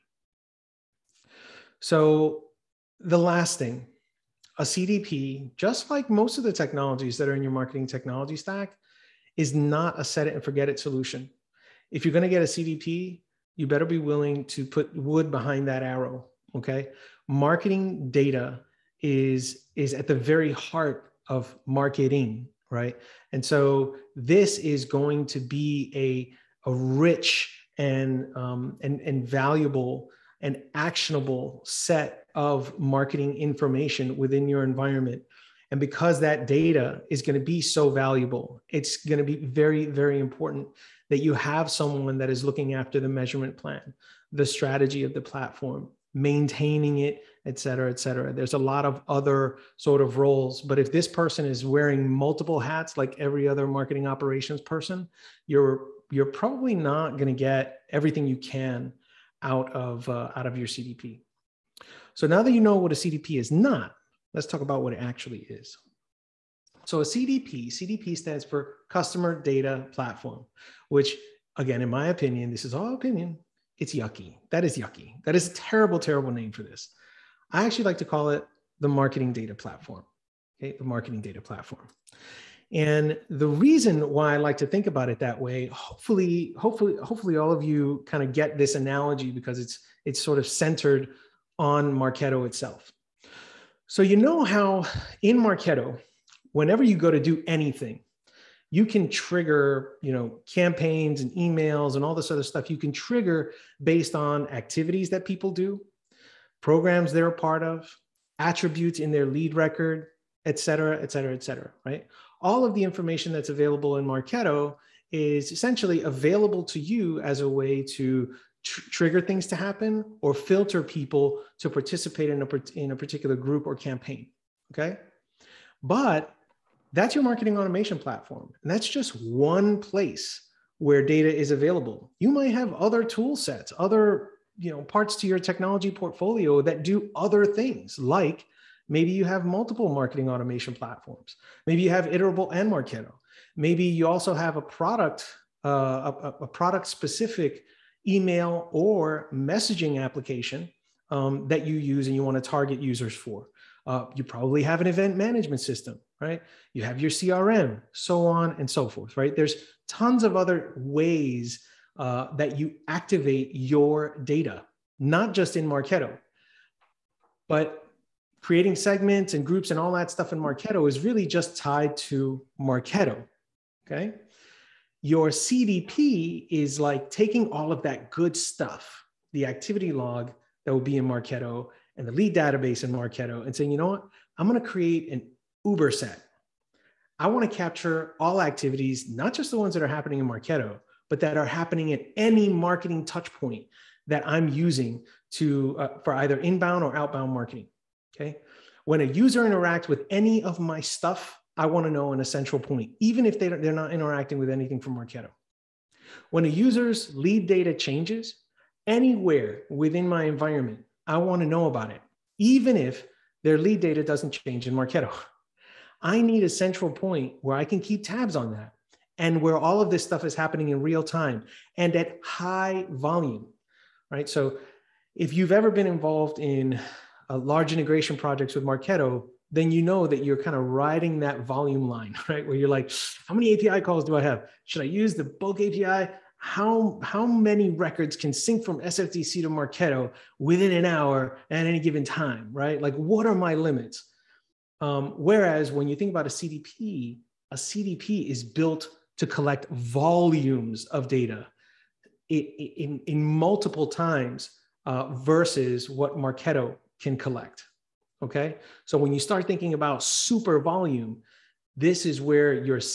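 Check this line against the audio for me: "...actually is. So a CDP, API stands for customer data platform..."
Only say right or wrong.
wrong.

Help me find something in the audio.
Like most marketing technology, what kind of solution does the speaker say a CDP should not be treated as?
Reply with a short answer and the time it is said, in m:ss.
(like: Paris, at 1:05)
set it and forget it, at 0:10.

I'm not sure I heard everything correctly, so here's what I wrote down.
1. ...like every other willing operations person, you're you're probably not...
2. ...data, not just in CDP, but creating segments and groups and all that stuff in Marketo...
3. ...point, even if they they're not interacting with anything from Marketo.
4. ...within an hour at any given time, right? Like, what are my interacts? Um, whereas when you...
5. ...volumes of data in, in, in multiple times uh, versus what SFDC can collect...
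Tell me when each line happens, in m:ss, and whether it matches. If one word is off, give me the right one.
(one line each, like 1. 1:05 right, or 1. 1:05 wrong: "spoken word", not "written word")
1. 0:52 wrong: "marketing", not "willing"
2. 2:44 wrong: "Marketo", not "CDP"
3. 3:22 right
4. 4:00 wrong: "limits", not "interacts"
5. 4:09 wrong: "Marketo", not "SFDC".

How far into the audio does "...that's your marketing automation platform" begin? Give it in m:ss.
2:06.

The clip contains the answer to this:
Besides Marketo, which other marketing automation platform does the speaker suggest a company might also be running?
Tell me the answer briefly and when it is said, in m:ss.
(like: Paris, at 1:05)
Iterable, at 2:22.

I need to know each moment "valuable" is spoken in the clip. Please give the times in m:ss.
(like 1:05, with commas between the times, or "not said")
0:29, 0:37.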